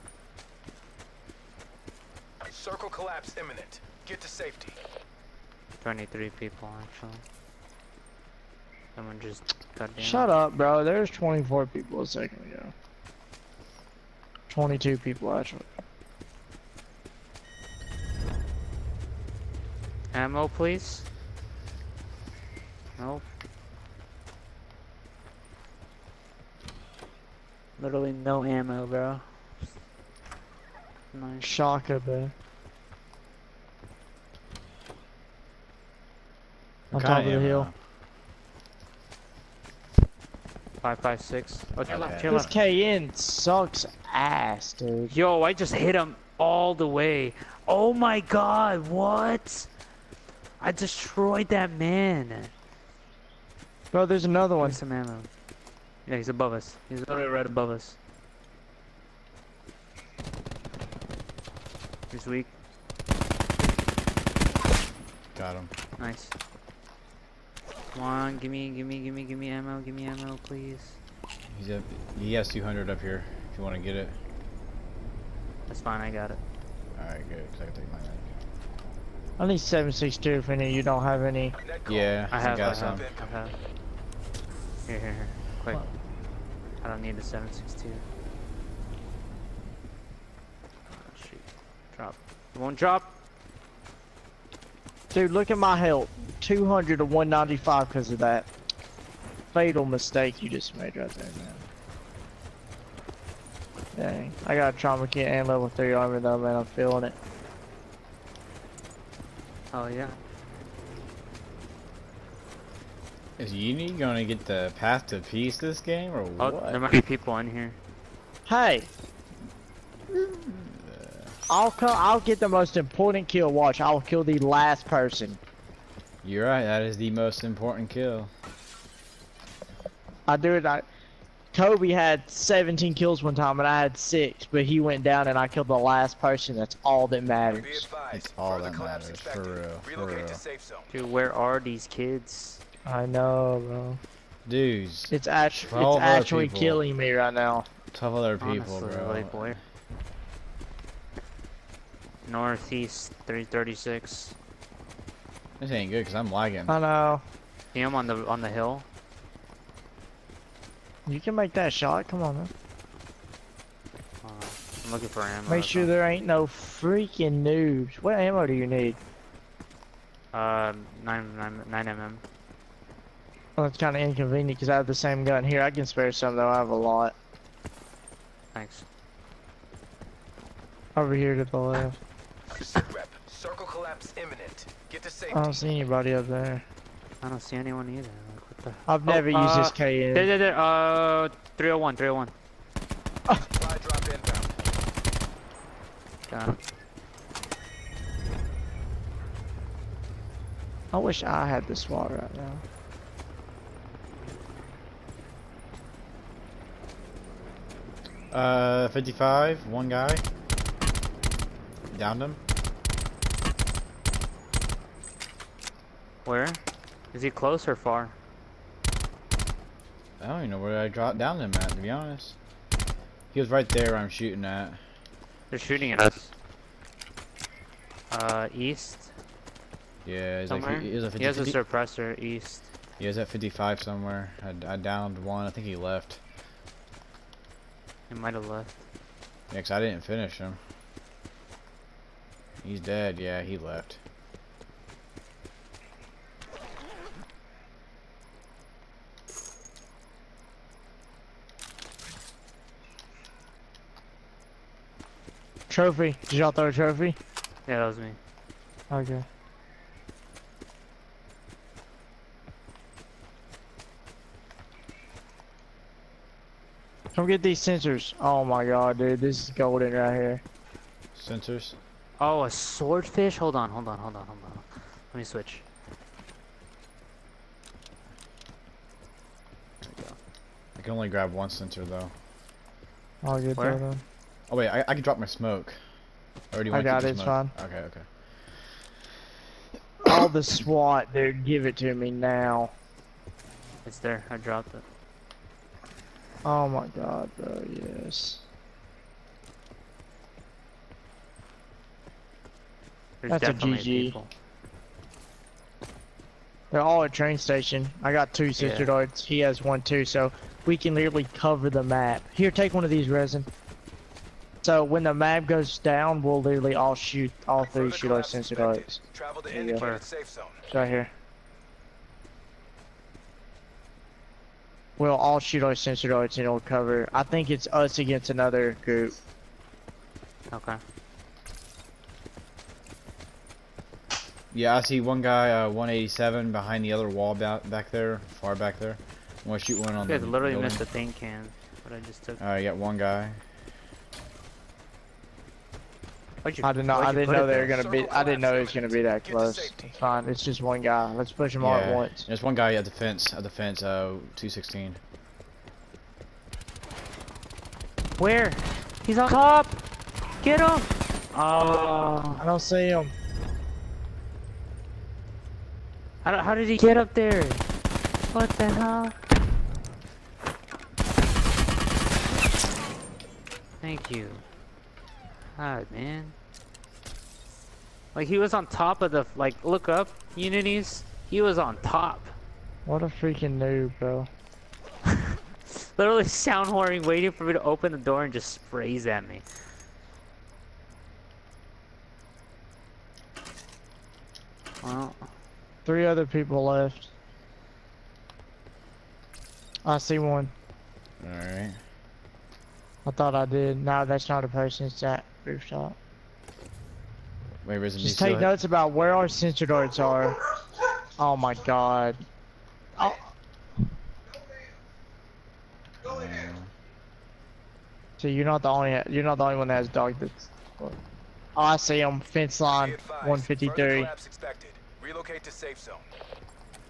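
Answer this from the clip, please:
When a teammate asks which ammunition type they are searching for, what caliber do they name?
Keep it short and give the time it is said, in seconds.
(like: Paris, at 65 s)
9mm, at 171 s.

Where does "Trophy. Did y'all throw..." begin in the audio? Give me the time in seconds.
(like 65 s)
255 s.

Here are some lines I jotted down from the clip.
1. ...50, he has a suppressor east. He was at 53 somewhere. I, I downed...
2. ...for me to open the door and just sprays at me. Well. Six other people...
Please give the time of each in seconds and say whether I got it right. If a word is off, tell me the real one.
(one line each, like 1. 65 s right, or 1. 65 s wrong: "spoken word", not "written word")
1. 231 s wrong: "55", not "53"
2. 387 s wrong: "Three", not "Six".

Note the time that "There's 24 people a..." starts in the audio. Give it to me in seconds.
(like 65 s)
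10 s.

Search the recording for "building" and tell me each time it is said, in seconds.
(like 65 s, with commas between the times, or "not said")
340 s.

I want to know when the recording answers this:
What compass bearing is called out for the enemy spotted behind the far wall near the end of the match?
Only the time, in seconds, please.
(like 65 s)
335 s.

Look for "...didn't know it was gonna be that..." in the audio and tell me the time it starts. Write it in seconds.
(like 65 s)
348 s.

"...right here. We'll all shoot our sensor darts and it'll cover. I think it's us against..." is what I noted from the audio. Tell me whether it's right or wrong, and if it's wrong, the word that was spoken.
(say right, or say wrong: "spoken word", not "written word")
right.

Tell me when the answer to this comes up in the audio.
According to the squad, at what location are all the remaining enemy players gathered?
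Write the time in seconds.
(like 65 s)
307 s.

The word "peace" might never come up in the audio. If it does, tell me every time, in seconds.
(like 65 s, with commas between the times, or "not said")
115 s.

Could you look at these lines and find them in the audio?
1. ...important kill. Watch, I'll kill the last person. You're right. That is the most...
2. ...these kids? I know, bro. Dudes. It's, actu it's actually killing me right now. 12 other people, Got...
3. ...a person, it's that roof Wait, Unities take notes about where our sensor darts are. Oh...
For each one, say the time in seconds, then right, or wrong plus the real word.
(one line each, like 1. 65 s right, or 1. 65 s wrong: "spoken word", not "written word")
1. 122 s right
2. 141 s wrong: "Honestly", not "Got"
3. 404 s wrong: "Just", not "Unities".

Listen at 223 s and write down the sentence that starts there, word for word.
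He was right there I'm shooting at.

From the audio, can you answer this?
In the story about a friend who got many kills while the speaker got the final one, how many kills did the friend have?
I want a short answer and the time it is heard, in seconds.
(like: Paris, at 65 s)
17, at 132 s.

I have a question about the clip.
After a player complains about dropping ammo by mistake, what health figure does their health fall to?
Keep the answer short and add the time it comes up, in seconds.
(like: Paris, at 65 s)
195, at 97 s.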